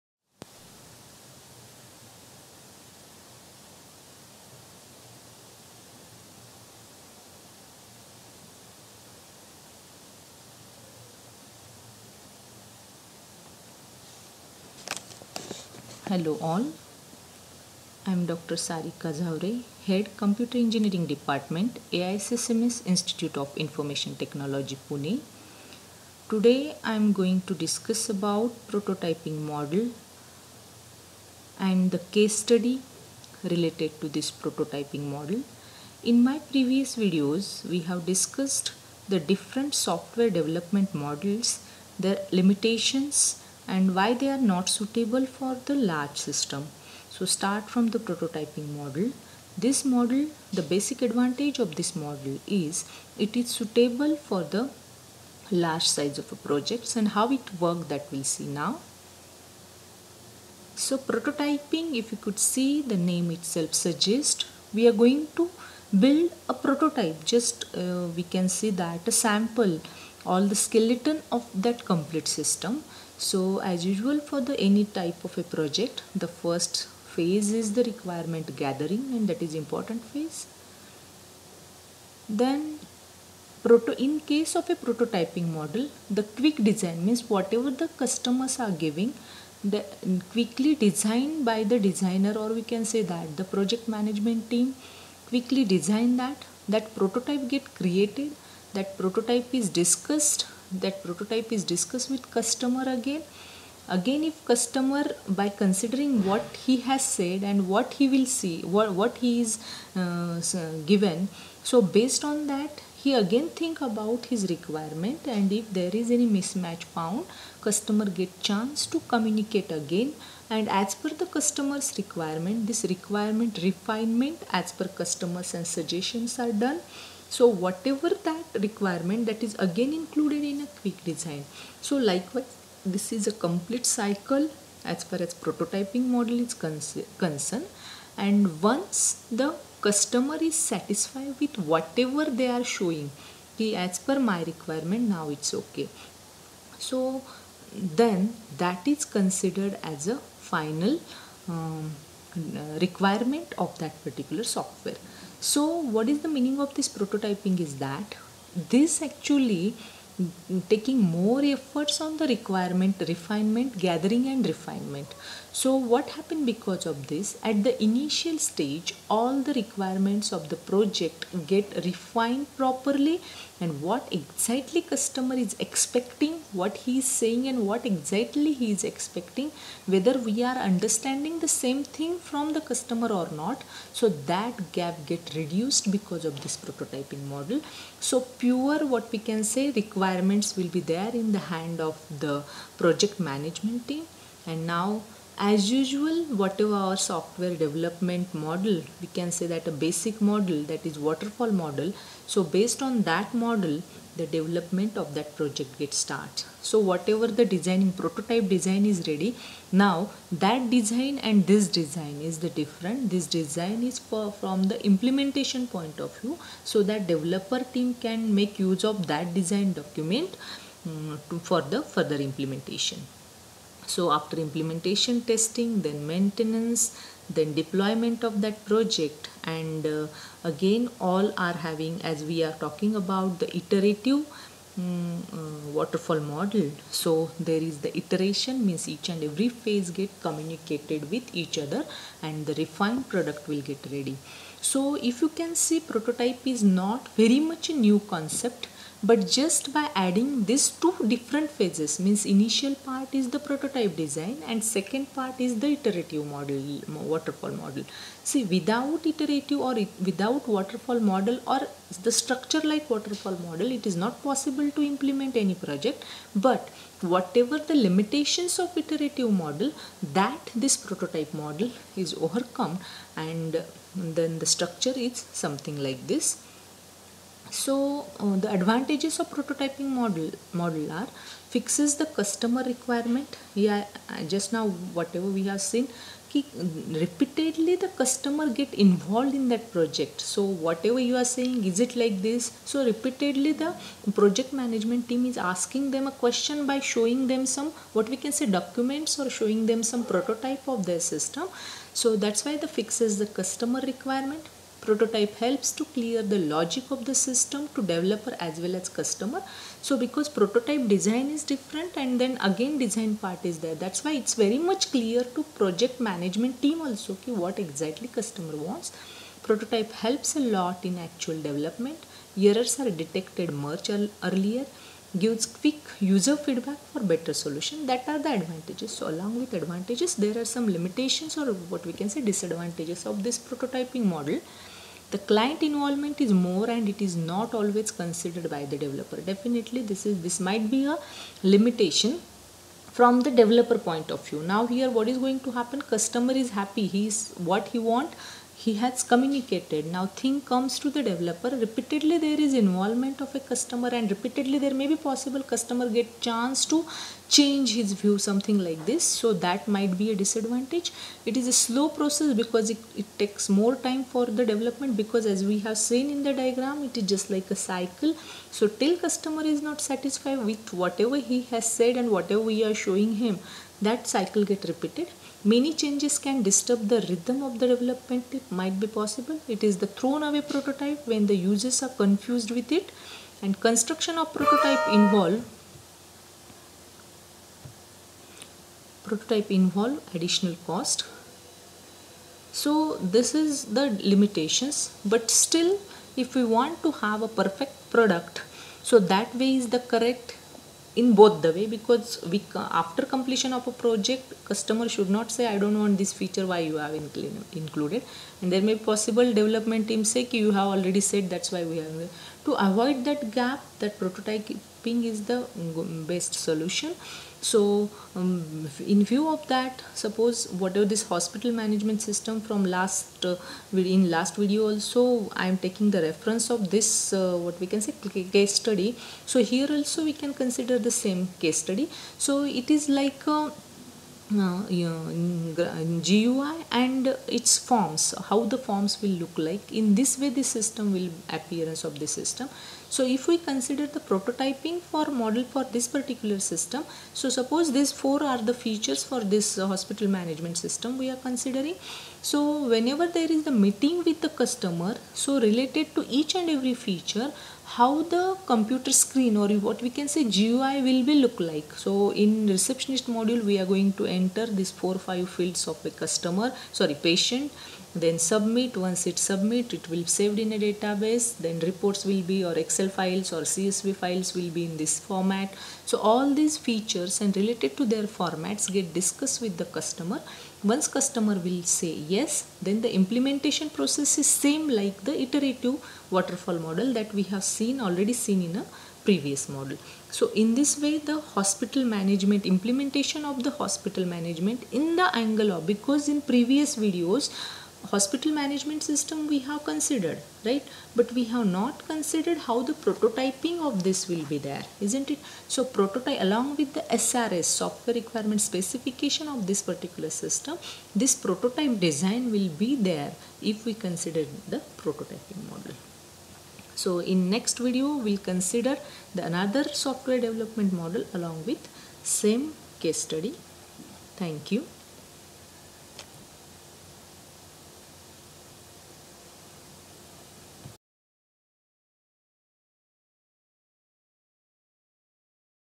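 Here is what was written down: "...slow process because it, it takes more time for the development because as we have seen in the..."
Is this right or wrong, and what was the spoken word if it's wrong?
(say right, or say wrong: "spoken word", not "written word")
right.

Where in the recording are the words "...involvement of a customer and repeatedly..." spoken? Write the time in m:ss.
5:52.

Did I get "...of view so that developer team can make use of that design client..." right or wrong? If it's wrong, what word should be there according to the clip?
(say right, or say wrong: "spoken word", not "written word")
wrong: "document", not "client".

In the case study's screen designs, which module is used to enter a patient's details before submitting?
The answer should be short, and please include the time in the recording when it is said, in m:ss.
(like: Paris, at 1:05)
Receptionist module, at 7:42.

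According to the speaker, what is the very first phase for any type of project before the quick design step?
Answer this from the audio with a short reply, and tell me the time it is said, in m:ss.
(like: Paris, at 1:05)
Requirement gathering, at 1:17.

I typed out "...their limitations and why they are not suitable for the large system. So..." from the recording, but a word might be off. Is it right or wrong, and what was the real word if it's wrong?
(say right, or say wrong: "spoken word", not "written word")
right.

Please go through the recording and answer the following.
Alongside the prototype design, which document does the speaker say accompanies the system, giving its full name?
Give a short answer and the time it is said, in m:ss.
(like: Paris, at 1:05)
Software requirement specification, at 8:27.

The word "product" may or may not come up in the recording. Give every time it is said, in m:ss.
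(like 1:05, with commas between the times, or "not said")
4:03, 6:37.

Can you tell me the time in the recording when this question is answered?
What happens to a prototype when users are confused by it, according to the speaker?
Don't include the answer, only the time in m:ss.
6:19.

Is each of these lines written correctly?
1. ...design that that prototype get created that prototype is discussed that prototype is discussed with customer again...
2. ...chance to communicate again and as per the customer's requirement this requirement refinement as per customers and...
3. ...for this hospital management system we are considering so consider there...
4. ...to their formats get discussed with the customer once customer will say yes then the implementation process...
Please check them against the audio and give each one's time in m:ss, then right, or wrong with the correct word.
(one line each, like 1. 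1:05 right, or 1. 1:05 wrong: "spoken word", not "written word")
1. 1:35 right
2. 1:58 right
3. 7:29 wrong: "whenever", not "consider"
4. 7:57 right.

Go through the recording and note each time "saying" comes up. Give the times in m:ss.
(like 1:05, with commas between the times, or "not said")
2:57, 4:51.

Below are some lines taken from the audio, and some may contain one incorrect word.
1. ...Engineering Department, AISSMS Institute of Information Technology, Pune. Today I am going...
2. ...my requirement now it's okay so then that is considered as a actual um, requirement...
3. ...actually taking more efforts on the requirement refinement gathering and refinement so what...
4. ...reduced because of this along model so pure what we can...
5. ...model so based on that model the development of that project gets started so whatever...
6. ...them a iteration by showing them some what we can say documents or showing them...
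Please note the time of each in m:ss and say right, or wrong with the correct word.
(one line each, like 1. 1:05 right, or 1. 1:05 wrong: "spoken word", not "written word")
1. 0:20 right
2. 2:24 wrong: "final", not "actual"
3. 2:39 right
4. 3:05 wrong: "prototyping", not "along"
5. 3:21 right
6. 4:55 wrong: "question", not "iteration".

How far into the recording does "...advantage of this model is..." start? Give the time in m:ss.
0:51.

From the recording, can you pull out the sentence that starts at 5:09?
So because prototype design is different and then again design part is there.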